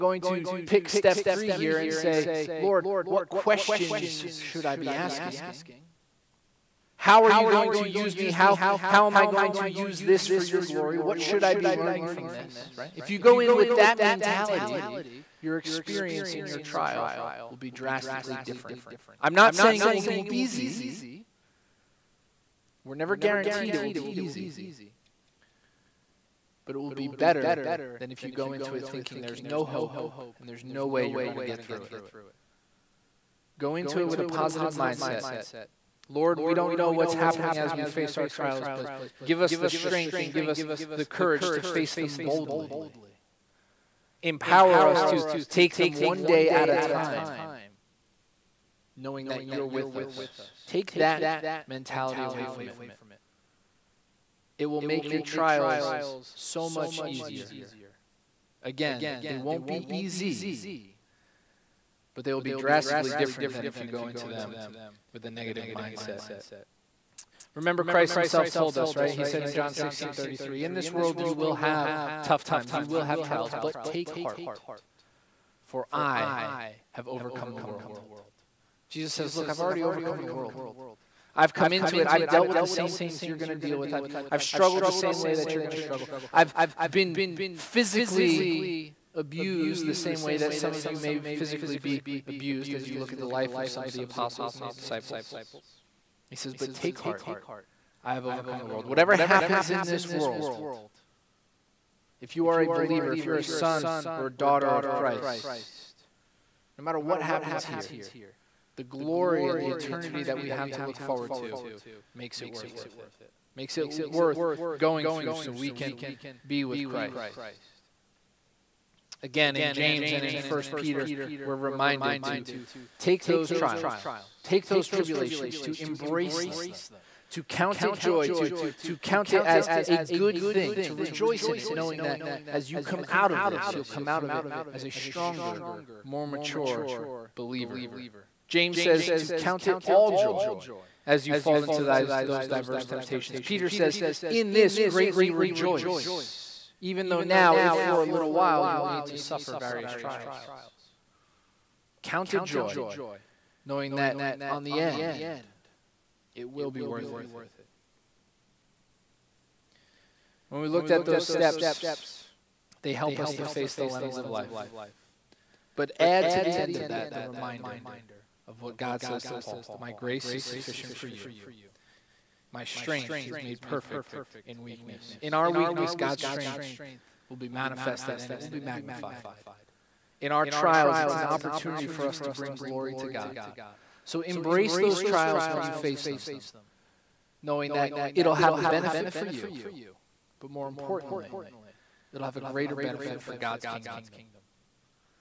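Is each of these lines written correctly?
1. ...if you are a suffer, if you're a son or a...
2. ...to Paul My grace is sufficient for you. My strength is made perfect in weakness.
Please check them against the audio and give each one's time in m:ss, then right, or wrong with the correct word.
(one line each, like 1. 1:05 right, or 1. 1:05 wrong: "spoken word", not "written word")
1. 1:42 wrong: "believer", not "suffer"
2. 2:49 right.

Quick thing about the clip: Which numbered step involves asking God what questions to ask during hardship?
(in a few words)
Step three.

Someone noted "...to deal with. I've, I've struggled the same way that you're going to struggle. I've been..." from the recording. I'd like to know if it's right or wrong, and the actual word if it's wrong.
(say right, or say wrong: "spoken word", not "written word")
right.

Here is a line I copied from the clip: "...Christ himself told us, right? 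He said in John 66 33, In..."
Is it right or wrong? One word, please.
wrong.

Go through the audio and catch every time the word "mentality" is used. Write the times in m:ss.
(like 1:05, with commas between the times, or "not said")
0:14, 0:51.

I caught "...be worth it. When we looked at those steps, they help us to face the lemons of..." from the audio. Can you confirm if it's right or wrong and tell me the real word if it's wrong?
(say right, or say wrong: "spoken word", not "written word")
right.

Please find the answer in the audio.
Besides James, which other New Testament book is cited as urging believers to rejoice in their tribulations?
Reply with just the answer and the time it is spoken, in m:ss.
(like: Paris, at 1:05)
1 Peter, at 2:00.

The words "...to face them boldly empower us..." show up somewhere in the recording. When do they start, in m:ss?
0:41.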